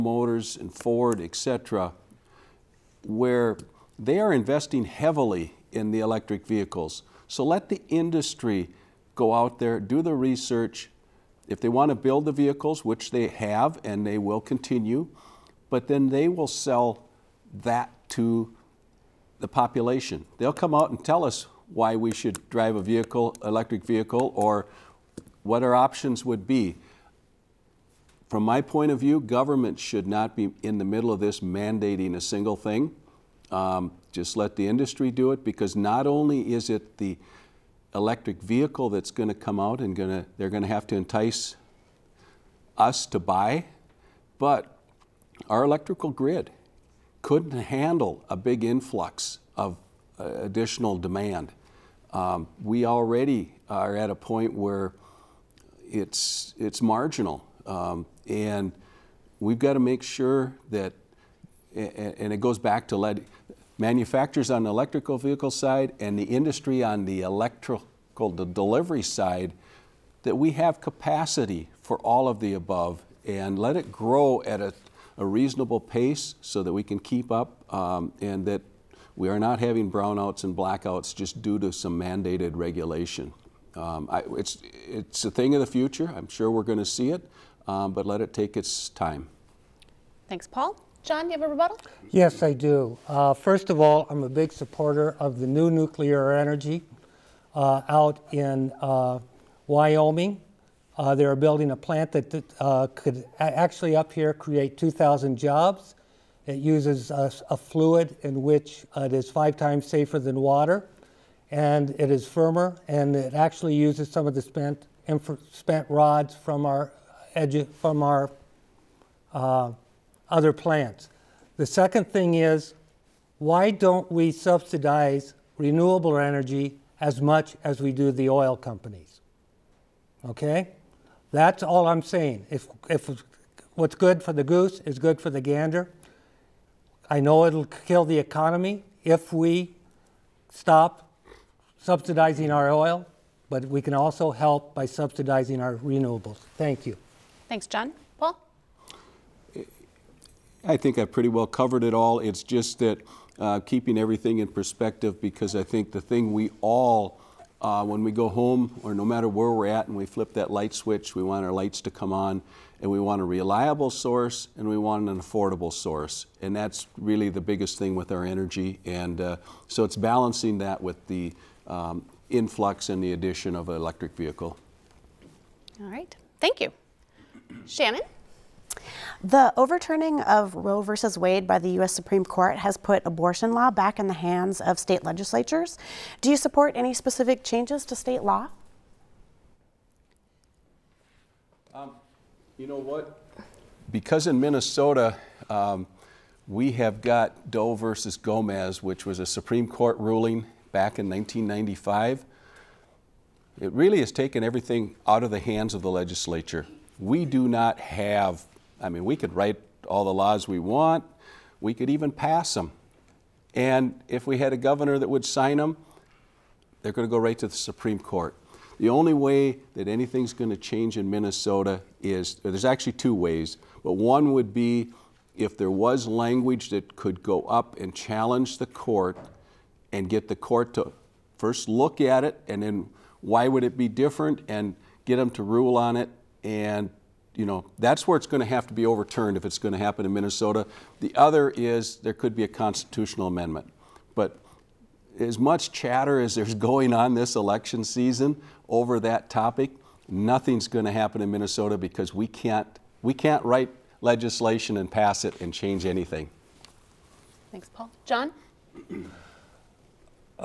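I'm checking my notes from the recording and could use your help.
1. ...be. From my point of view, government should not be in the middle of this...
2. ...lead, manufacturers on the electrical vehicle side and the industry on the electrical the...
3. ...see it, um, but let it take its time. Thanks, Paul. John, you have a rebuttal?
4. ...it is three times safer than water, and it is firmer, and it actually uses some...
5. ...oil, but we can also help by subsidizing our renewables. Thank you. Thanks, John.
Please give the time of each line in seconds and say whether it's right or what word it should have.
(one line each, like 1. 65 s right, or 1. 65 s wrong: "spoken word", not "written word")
1. 26 s right
2. 62 s right
3. 86 s right
4. 108 s wrong: "five", not "three"
5. 142 s right.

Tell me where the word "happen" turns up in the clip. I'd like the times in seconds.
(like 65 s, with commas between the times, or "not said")
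239 s, 250 s.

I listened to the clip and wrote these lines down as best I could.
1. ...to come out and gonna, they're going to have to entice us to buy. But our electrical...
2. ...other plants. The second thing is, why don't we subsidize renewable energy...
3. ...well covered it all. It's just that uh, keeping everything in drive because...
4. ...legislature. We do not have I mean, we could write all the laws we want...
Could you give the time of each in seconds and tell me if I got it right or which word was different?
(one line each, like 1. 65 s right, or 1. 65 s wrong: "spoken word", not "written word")
1. 39 s right
2. 120 s right
3. 151 s wrong: "perspective", not "drive"
4. 205 s right.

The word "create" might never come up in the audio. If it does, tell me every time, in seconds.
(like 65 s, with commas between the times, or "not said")
104 s.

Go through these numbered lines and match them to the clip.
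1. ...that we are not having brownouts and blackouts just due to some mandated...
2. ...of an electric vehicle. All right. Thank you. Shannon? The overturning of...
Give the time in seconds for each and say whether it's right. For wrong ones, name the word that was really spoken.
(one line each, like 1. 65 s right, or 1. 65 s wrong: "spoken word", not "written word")
1. 78 s right
2. 173 s right.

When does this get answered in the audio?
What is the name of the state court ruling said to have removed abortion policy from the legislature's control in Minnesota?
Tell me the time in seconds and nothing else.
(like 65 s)
197 s.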